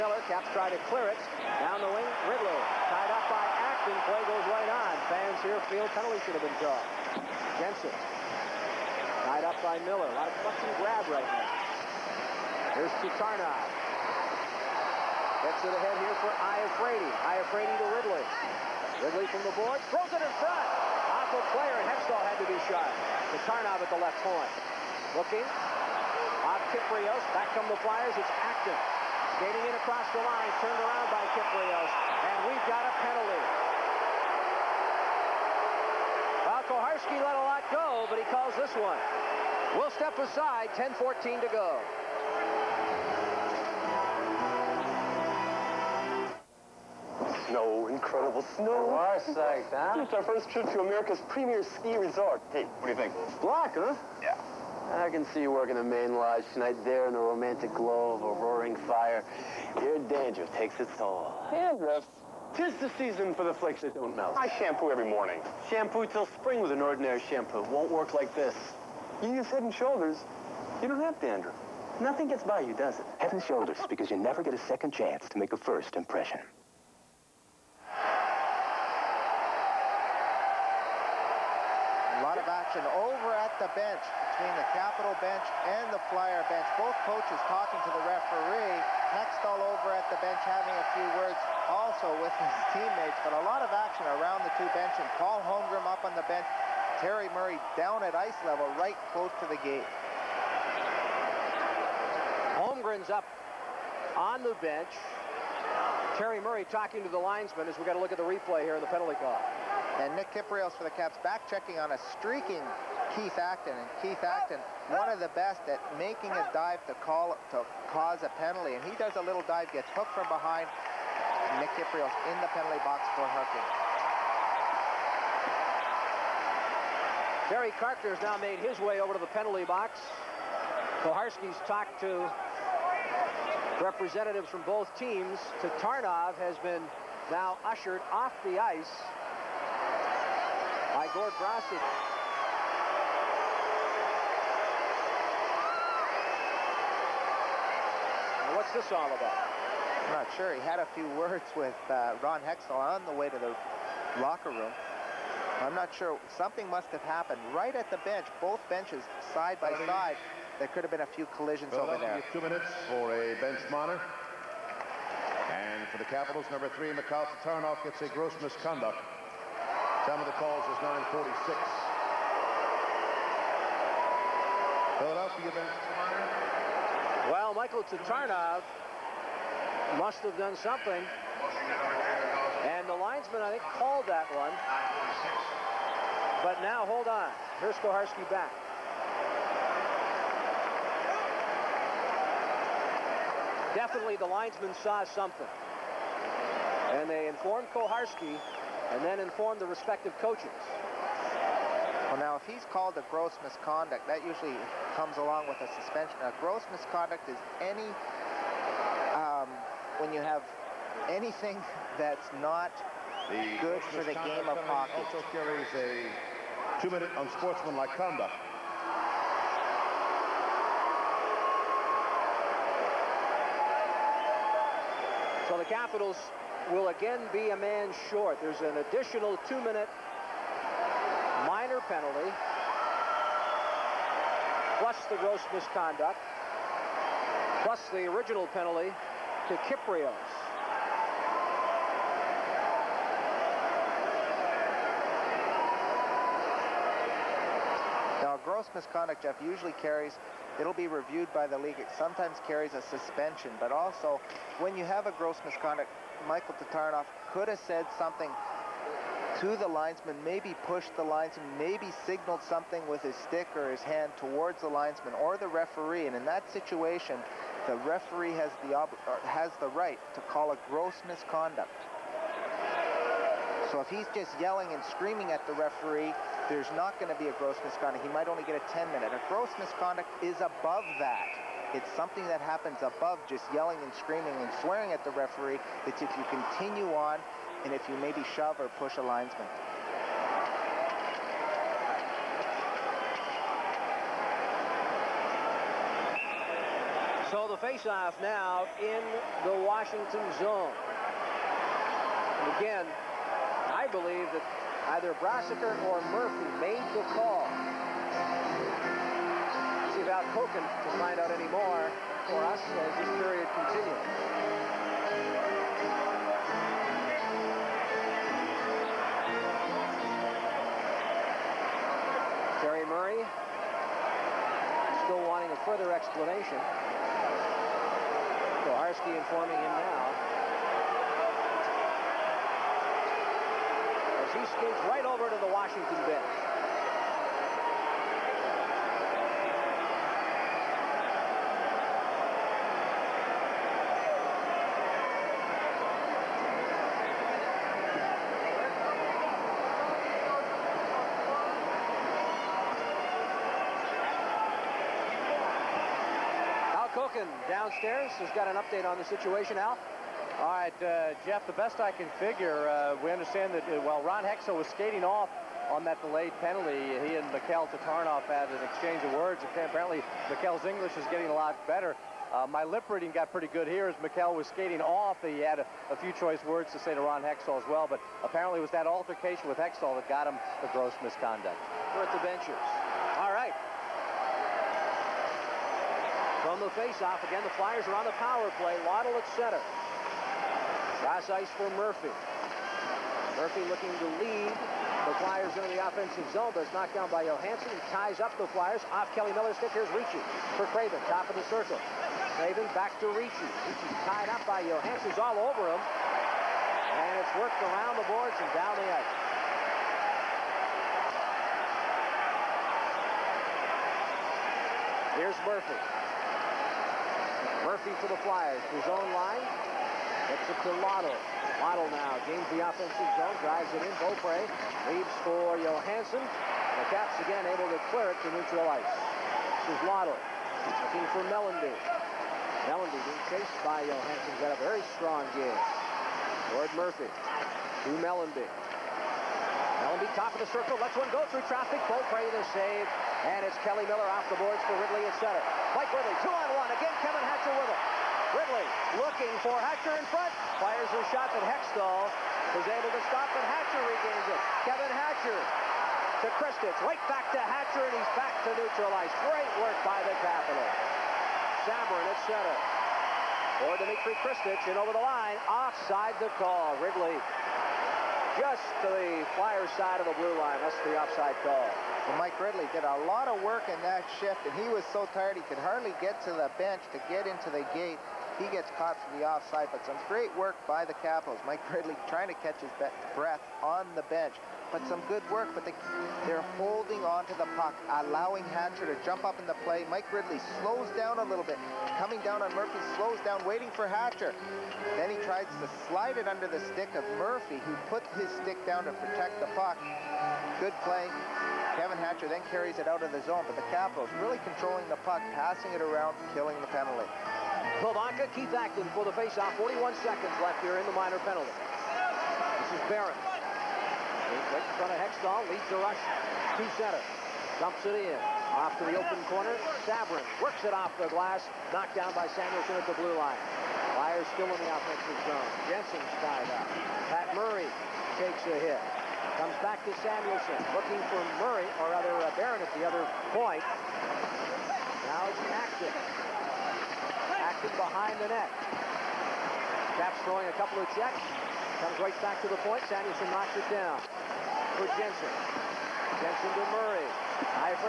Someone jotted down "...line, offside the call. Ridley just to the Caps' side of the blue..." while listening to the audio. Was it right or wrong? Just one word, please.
wrong.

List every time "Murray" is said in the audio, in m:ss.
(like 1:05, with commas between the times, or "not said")
1:37, 1:46, 5:22, 8:47, 8:51, 9:06.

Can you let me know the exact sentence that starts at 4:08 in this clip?
Now, gross misconduct, Jeff, usually carries, it'll be reviewed by the league.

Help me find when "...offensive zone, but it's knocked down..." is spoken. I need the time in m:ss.
6:35.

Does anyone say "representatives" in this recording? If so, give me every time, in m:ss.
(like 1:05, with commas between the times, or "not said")
2:13.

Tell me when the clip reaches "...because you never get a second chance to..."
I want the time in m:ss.
1:13.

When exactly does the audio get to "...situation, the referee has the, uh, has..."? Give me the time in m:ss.
4:26.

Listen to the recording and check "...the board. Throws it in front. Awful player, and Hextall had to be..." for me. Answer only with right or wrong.
right.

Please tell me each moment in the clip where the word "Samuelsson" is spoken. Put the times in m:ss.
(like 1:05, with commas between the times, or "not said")
8:42, 8:50.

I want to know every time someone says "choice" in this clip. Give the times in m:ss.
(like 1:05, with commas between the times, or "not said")
6:16.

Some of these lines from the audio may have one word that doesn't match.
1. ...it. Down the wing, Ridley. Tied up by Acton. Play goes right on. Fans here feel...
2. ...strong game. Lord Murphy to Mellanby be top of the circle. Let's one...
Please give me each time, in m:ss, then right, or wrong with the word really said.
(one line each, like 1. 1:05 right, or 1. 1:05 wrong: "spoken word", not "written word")
1. 0:01 right
2. 7:14 right.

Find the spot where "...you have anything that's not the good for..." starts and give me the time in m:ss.
3:30.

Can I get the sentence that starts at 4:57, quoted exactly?
faceoff now in the Washington zone.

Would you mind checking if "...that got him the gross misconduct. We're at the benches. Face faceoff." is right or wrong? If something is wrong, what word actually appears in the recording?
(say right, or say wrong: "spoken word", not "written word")
right.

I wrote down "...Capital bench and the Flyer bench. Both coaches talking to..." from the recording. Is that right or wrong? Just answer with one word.
right.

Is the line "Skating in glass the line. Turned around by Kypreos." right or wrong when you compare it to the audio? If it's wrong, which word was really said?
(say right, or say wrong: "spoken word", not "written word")
wrong: "across", not "glass".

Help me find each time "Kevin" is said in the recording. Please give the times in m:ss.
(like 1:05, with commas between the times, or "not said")
7:27, 7:34, 8:21.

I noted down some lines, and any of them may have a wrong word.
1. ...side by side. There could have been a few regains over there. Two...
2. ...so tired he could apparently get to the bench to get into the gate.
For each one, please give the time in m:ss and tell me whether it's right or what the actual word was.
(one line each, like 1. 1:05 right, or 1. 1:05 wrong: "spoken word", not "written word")
1. 2:39 wrong: "collisions", not "regains"
2. 7:54 wrong: "hardly", not "apparently".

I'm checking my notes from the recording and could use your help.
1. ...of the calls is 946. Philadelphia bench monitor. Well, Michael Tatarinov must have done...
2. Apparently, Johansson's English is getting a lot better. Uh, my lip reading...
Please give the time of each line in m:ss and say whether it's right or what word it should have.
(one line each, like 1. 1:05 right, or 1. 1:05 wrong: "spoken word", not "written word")
1. 2:50 right
2. 6:09 wrong: "Mikhail", not "Johansson".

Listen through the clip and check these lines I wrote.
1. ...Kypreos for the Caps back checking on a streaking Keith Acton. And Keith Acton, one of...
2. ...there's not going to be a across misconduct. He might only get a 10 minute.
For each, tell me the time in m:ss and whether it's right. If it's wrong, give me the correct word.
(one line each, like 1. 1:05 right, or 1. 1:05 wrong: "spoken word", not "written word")
1. 1:50 right
2. 4:36 wrong: "gross", not "across".